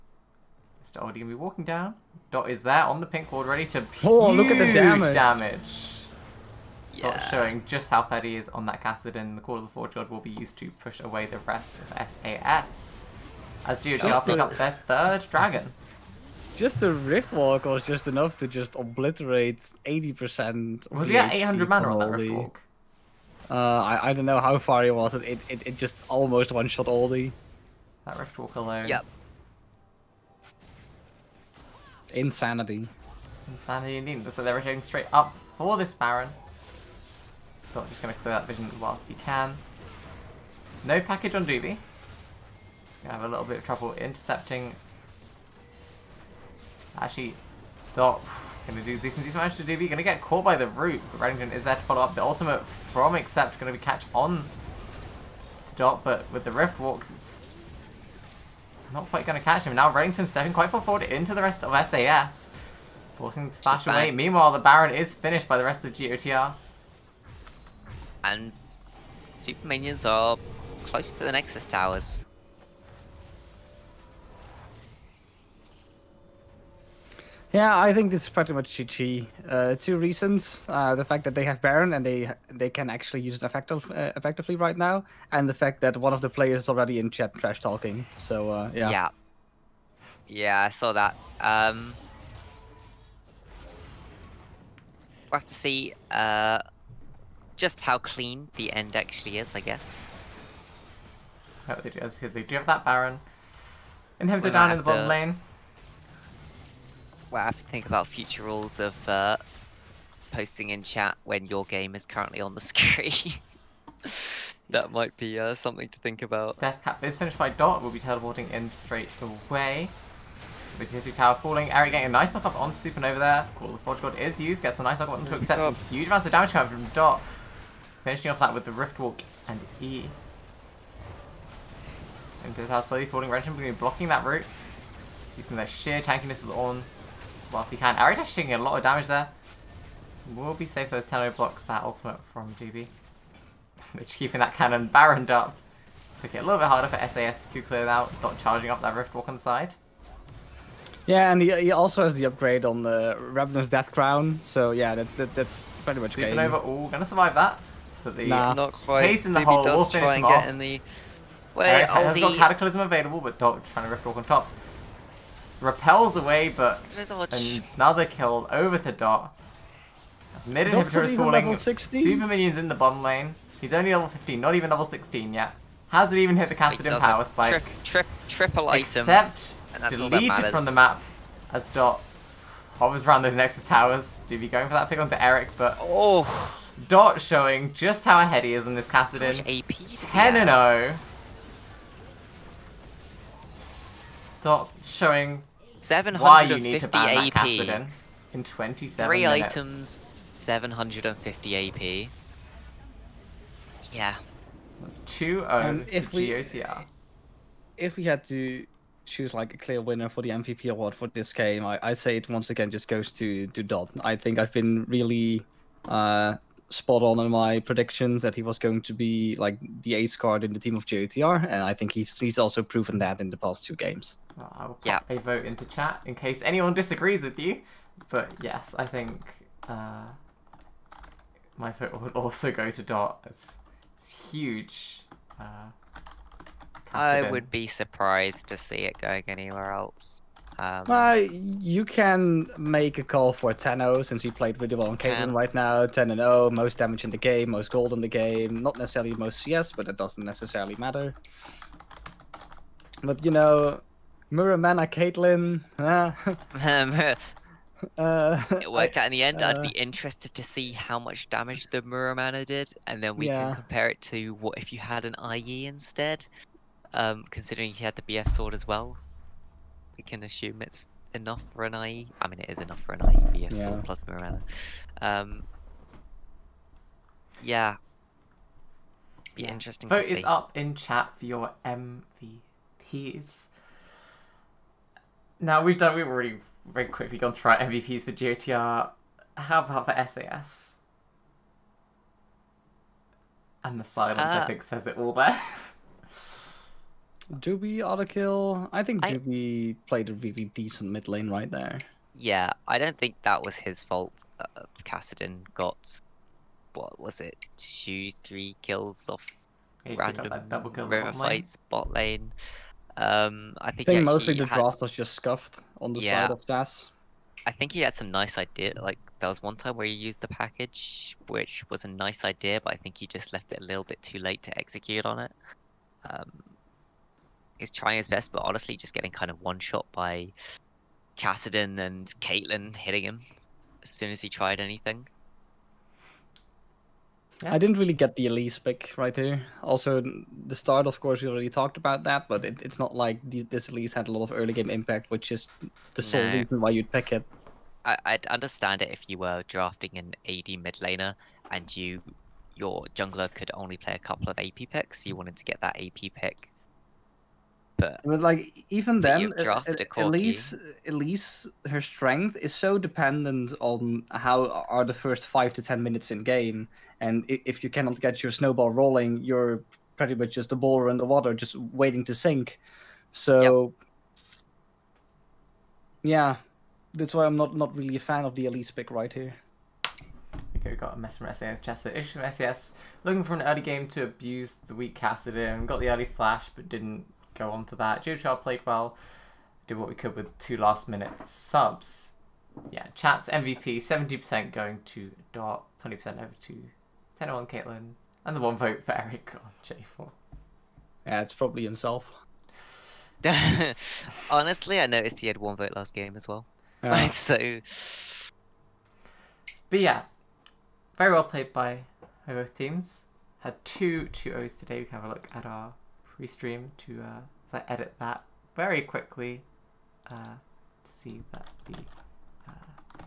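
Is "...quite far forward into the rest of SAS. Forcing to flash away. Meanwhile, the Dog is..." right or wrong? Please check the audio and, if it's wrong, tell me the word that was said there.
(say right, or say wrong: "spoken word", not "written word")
wrong: "Baron", not "Dog".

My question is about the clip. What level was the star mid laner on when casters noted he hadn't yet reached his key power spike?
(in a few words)
15.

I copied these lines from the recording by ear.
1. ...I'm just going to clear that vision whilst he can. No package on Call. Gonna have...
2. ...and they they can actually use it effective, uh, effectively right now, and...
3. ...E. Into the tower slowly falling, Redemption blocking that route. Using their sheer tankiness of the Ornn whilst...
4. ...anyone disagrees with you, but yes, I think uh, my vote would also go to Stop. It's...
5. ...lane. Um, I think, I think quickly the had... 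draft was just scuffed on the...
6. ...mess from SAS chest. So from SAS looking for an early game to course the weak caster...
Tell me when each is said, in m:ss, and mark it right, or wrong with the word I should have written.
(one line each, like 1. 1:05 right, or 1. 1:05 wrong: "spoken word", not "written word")
1. 0:37 wrong: "Doobie", not "Call"
2. 1:21 right
3. 2:09 right
4. 3:46 wrong: "Dot", not "Stop"
5. 5:11 wrong: "mostly", not "quickly"
6. 6:20 wrong: "abuse", not "course".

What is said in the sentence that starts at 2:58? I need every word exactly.
Except deleted from the map as Dot hovers around those Nexus towers.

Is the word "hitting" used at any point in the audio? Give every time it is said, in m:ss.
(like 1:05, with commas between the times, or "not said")
5:32.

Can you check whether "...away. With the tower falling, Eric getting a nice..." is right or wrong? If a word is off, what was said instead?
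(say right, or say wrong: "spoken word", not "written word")
right.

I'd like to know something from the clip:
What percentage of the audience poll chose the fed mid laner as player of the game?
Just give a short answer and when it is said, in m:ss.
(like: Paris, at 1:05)
70%, at 6:33.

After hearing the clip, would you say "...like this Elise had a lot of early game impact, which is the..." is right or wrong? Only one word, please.
right.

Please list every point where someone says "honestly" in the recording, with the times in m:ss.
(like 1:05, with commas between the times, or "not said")
5:28, 6:44.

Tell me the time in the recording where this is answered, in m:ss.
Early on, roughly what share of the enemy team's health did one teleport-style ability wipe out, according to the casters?
0:19.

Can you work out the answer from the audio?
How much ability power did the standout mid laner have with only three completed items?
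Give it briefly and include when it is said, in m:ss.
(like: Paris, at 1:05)
750, at 3:20.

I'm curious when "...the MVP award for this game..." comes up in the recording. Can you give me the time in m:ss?
3:30.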